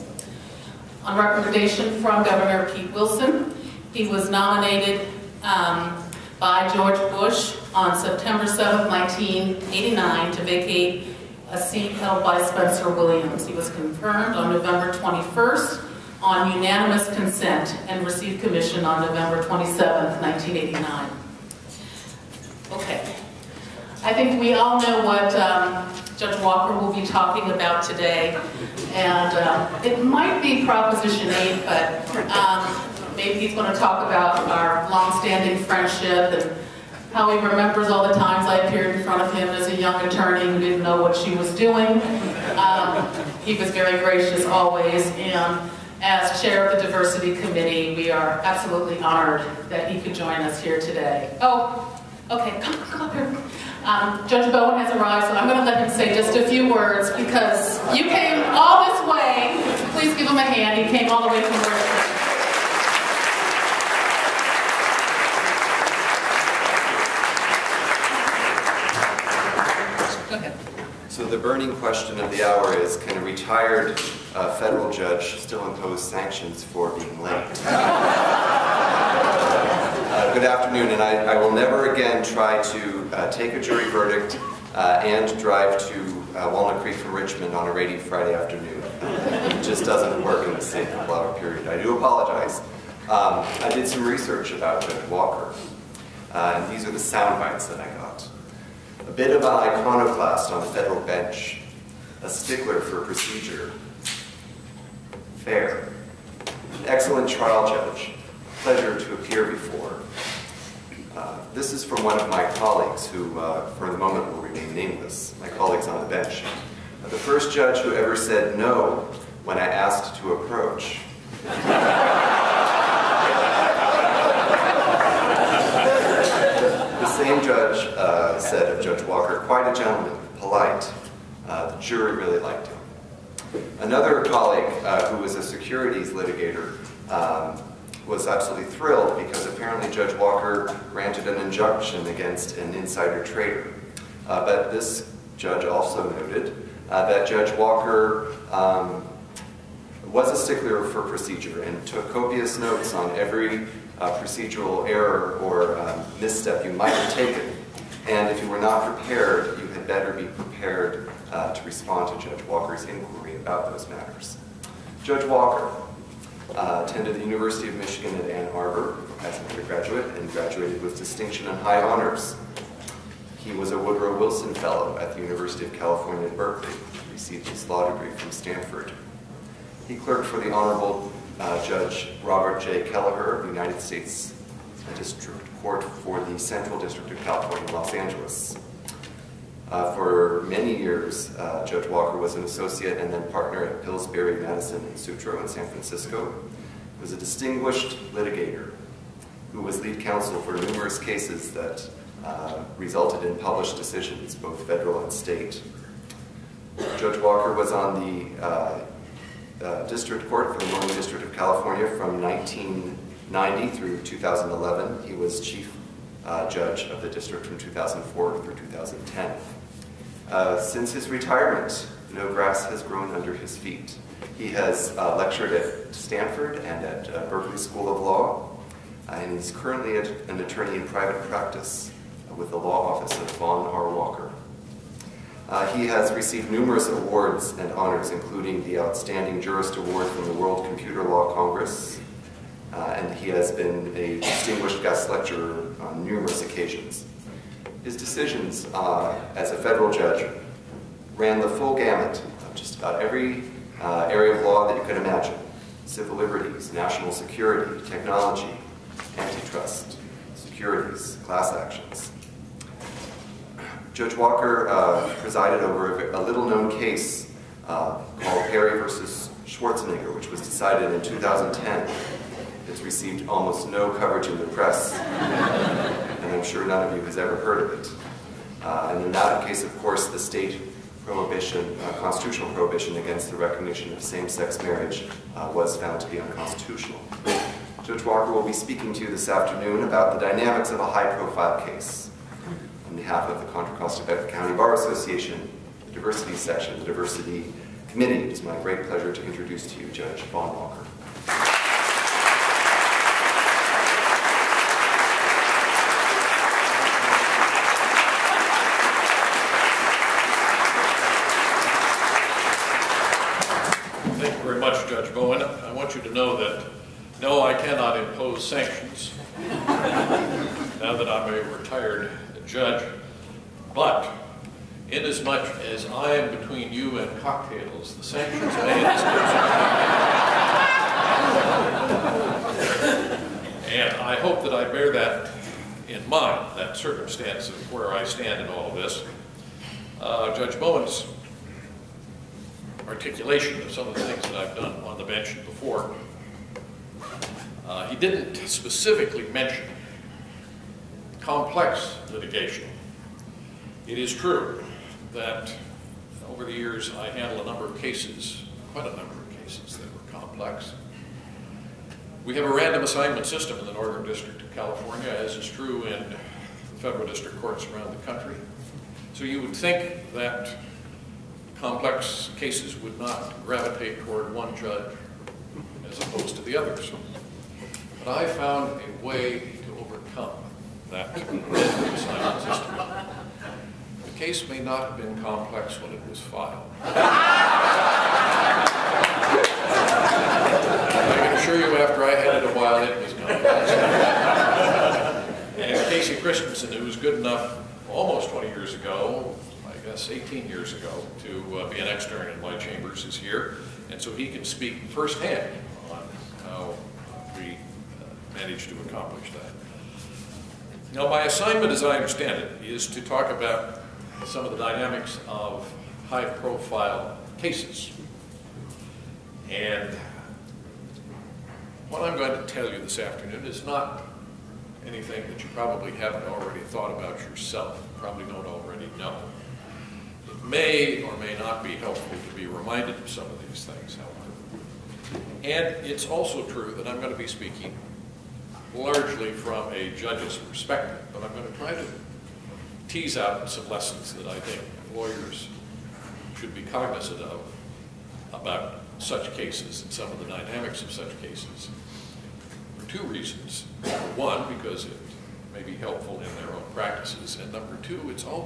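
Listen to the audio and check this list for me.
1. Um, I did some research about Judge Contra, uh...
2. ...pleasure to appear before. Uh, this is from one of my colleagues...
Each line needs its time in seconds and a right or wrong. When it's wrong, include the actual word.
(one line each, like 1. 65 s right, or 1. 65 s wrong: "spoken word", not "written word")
1. 93 s wrong: "Walker", not "Contra"
2. 108 s right.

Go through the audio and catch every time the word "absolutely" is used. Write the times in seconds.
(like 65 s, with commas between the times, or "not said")
48 s, 138 s.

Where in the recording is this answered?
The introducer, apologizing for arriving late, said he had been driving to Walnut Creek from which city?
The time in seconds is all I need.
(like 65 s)
87 s.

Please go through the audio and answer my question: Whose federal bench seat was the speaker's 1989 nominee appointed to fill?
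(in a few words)
Spencer Williams.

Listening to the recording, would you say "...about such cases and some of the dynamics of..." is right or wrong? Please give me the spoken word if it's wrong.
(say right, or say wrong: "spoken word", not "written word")
right.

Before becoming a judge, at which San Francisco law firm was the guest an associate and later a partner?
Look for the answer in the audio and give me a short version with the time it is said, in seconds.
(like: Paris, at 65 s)
Pillsbury, Madison, and Sutro, at 193 s.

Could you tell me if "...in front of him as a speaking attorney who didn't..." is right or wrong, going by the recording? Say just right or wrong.
wrong.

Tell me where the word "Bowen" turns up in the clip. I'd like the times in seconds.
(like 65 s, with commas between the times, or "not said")
54 s, 340 s.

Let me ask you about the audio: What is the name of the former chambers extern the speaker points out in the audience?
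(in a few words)
Casey Christensen.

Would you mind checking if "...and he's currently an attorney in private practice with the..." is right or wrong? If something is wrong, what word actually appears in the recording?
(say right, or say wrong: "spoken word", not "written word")
right.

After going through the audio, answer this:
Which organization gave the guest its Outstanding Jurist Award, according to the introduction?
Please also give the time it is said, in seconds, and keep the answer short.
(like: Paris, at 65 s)
World Computer Law Congress, at 240 s.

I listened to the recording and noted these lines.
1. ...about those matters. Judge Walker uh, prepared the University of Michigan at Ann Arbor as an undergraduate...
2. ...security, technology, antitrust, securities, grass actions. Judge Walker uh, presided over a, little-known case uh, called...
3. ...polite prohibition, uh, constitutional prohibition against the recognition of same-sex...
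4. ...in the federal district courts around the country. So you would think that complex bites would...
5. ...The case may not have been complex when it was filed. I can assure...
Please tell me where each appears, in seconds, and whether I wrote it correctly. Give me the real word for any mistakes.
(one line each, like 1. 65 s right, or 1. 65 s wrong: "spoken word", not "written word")
1. 163 s wrong: "attended", not "prepared"
2. 257 s wrong: "class", not "grass"
3. 280 s wrong: "state", not "polite"
4. 365 s wrong: "cases", not "bites"
5. 381 s right.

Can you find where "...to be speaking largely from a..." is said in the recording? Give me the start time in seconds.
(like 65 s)
437 s.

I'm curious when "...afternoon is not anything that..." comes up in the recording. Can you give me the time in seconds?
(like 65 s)
422 s.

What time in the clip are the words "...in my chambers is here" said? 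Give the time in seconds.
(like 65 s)
402 s.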